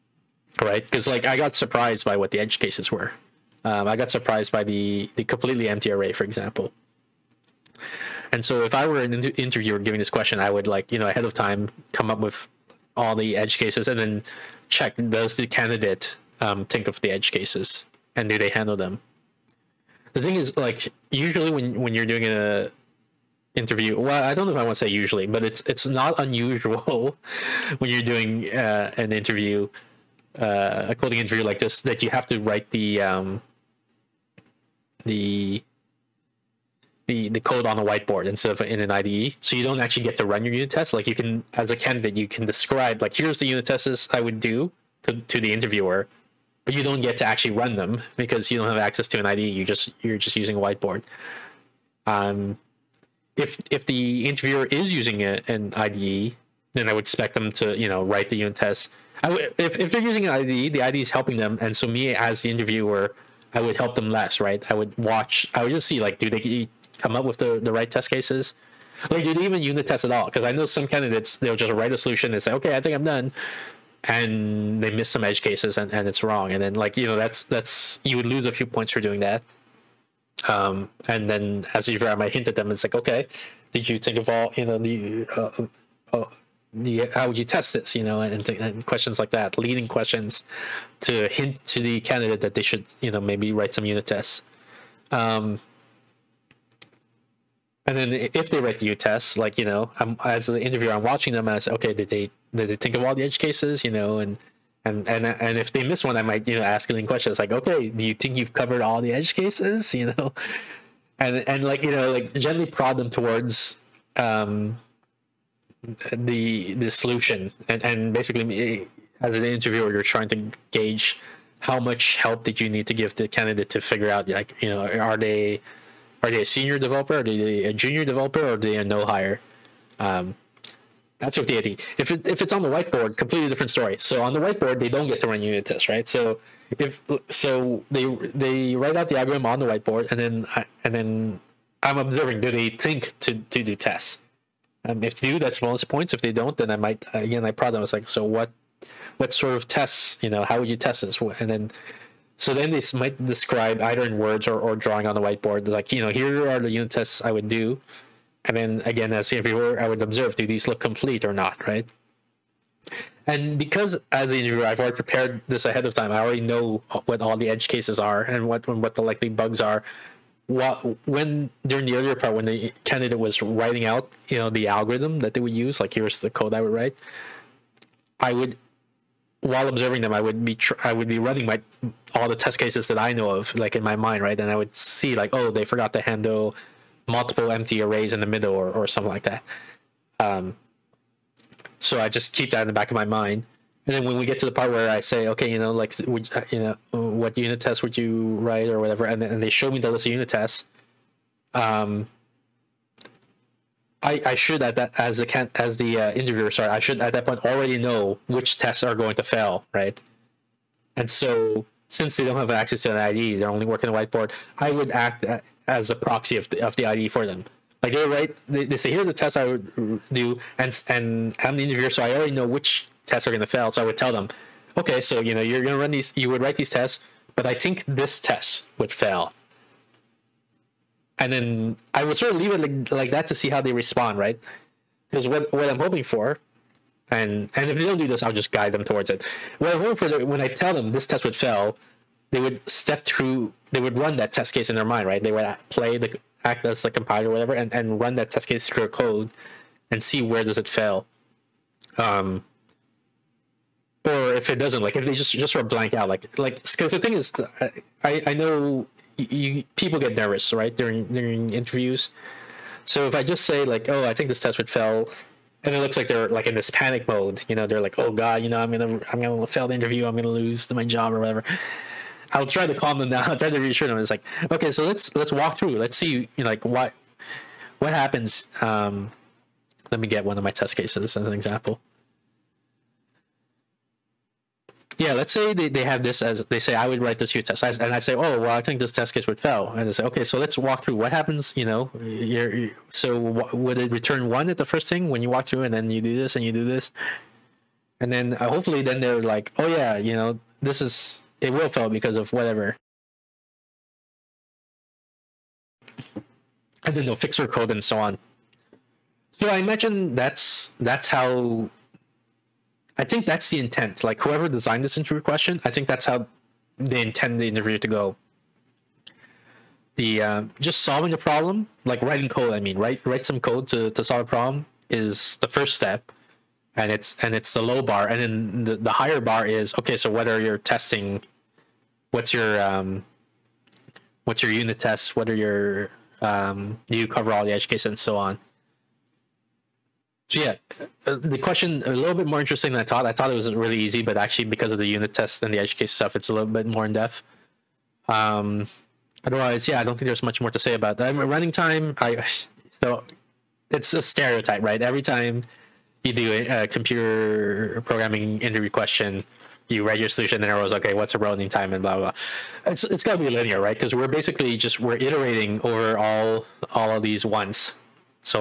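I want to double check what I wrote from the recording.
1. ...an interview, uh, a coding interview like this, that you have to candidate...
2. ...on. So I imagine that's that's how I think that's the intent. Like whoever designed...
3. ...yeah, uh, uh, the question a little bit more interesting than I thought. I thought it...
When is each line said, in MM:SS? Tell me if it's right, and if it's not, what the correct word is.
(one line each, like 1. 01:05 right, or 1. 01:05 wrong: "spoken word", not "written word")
1. 00:28 wrong: "write", not "candidate"
2. 05:07 right
3. 05:40 right.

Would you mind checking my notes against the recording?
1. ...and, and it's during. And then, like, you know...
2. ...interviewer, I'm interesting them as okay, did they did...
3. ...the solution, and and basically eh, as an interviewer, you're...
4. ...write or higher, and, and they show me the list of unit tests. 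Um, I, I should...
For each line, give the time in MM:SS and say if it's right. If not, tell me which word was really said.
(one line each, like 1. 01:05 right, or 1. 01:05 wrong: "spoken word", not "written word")
1. 01:15 wrong: "wrong", not "during"
2. 01:40 wrong: "watching", not "interesting"
3. 01:56 right
4. 03:18 wrong: "whatever", not "higher".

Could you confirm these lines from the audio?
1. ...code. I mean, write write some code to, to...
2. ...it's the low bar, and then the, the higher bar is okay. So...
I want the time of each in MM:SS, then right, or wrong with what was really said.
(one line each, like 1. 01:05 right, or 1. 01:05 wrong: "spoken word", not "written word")
1. 05:22 right
2. 05:27 right.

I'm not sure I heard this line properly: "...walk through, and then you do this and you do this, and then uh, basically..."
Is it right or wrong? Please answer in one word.
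wrong.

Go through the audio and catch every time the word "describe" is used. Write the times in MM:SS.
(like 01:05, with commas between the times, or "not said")
00:42, 02:33.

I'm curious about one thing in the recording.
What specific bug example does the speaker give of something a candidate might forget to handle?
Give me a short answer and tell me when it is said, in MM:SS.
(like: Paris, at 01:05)
multiple empty arrays in the middle, at 03:07.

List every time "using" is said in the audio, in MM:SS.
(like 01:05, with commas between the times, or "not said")
00:50, 00:54, 01:00.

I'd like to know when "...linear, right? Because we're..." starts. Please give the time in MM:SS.
06:03.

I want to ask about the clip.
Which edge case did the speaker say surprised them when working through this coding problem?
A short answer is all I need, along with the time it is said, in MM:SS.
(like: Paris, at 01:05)
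the completely empty array, at 00:05.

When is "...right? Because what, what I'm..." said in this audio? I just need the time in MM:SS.
03:54.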